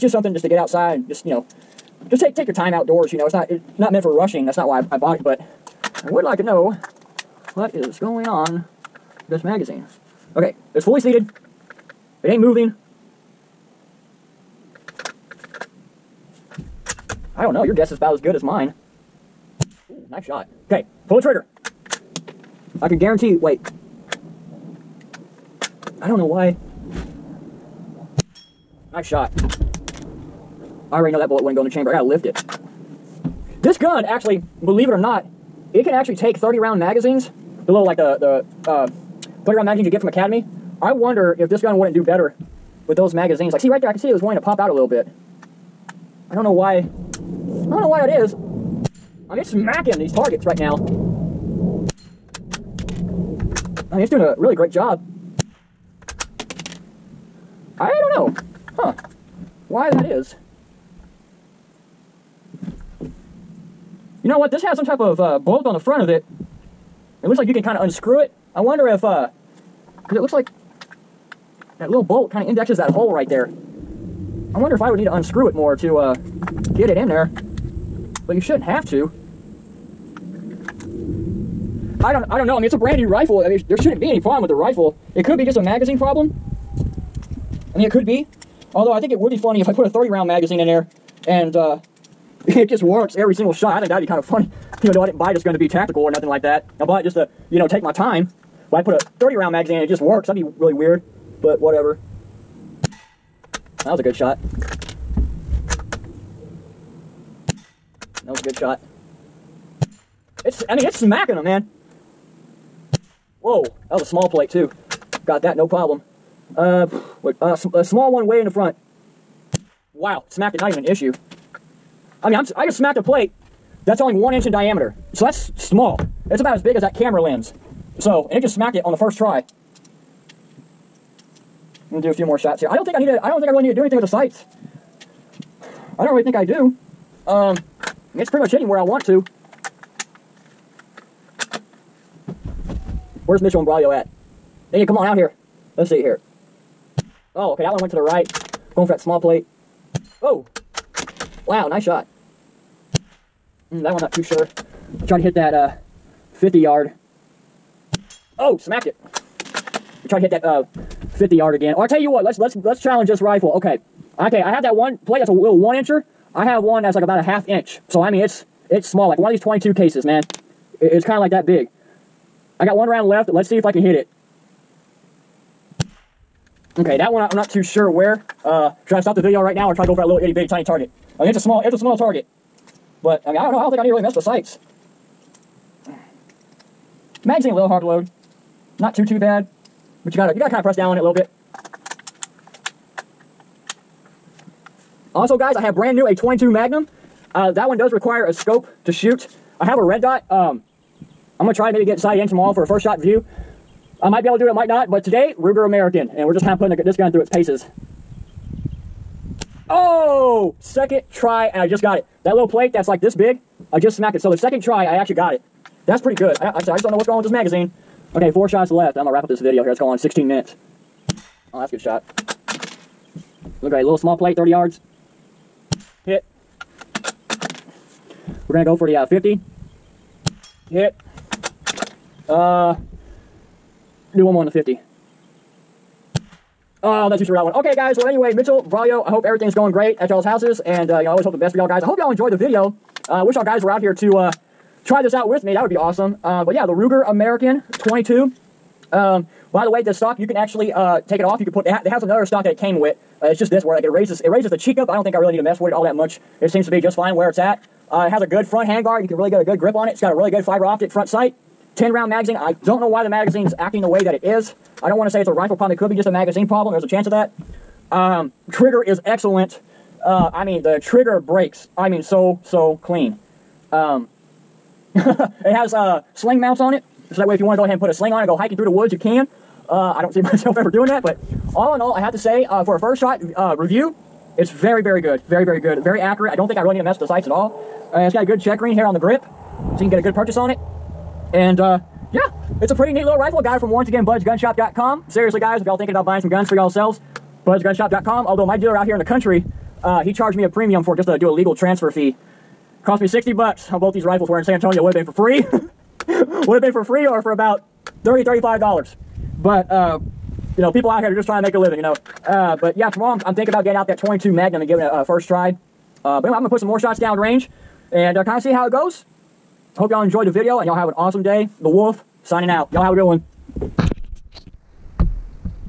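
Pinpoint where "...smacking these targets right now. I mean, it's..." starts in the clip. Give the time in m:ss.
0:49.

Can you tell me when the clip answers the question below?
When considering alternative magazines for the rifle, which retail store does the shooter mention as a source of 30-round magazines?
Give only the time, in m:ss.
0:40.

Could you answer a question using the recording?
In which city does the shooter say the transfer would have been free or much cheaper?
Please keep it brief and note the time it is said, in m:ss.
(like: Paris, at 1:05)
San Antonio, at 5:04.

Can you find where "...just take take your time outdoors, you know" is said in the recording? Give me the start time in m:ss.
0:02.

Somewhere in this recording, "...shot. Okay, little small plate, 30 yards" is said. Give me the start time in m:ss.
3:41.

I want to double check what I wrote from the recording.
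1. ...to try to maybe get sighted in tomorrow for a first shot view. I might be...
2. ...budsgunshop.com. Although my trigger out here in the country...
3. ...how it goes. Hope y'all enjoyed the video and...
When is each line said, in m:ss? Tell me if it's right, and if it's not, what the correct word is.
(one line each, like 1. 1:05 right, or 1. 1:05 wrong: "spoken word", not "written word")
1. 3:21 right
2. 4:57 wrong: "dealer", not "trigger"
3. 5:18 right.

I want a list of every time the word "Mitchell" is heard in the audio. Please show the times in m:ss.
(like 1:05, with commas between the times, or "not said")
2:23, 3:58.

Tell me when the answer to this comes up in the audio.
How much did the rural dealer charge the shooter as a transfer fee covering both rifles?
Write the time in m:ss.
5:03.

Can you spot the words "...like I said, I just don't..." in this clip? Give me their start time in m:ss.
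3:36.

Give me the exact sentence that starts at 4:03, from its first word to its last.
Uh, I uh, wish y'all guys were out here to...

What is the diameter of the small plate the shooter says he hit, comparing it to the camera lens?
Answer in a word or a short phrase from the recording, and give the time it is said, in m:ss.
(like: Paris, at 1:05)
1 inch, at 2:04.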